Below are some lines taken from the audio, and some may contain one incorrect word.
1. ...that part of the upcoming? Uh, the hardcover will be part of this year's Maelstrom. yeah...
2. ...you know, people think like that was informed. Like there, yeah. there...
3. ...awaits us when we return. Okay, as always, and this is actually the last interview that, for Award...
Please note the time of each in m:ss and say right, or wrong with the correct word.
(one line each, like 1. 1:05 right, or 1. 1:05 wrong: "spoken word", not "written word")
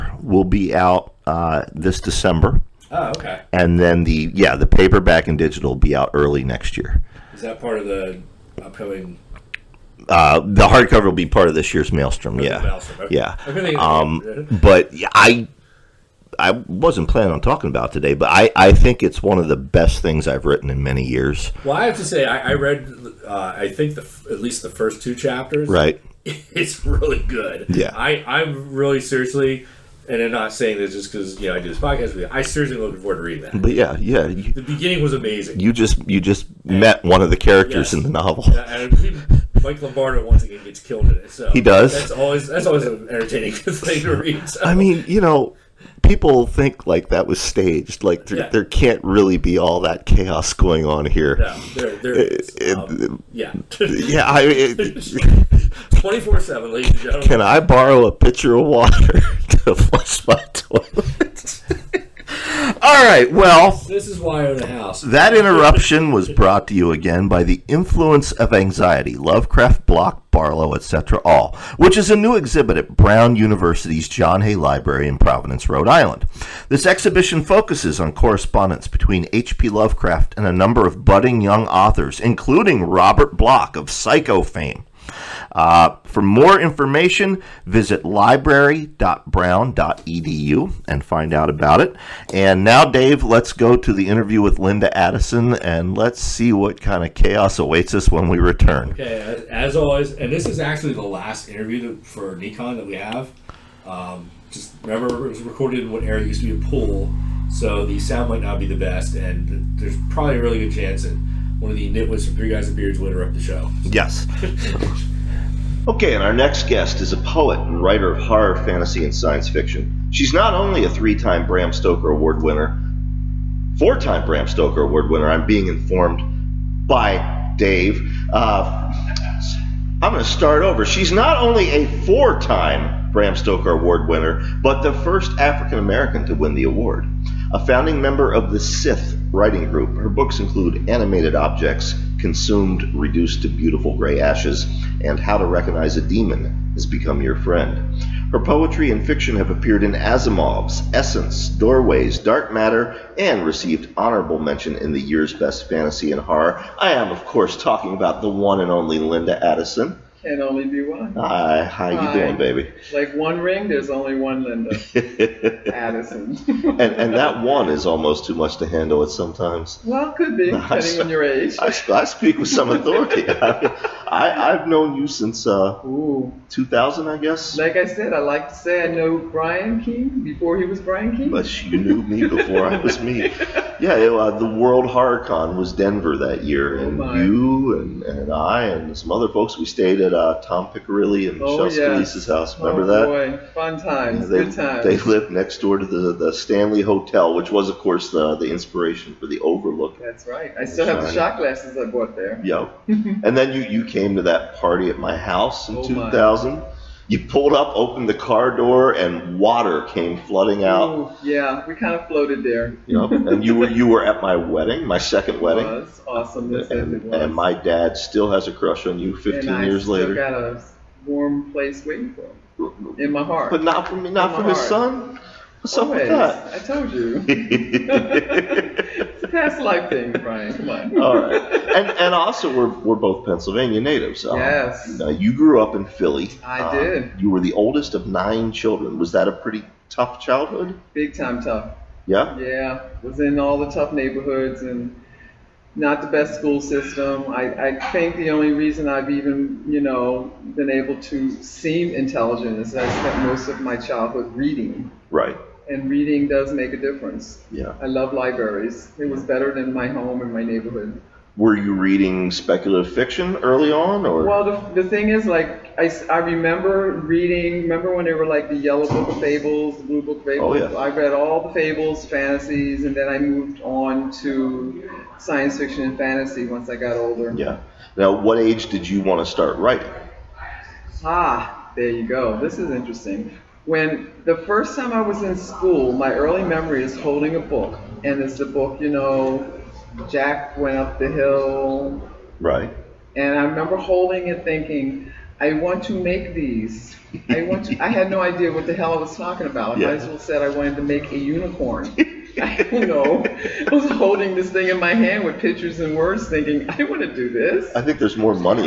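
1. 0:07 right
2. 0:45 wrong: "staged", not "informed"
3. 1:37 wrong: "Necon", not "Award".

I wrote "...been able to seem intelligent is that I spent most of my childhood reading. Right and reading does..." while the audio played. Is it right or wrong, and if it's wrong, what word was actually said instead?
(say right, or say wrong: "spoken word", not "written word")
right.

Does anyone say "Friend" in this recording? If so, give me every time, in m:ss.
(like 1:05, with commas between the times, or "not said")
2:27.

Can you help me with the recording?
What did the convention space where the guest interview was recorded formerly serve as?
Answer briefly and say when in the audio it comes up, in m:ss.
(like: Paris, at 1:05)
a pool, at 1:46.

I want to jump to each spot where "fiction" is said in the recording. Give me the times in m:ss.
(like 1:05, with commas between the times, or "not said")
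1:59, 2:29, 4:22, 4:35.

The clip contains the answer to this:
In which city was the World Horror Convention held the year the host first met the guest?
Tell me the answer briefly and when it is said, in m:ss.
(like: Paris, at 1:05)
Denver, at 3:05.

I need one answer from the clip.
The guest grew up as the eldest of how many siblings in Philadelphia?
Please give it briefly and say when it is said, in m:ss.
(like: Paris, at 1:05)
9, at 3:58.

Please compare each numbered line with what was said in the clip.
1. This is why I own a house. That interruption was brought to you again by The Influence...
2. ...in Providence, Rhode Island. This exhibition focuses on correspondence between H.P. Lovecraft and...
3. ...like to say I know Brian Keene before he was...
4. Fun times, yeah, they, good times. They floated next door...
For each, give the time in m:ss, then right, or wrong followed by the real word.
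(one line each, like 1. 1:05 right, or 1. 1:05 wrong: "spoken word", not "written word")
1. 1:03 right
2. 1:15 right
3. 2:58 right
4. 3:13 wrong: "lived", not "floated".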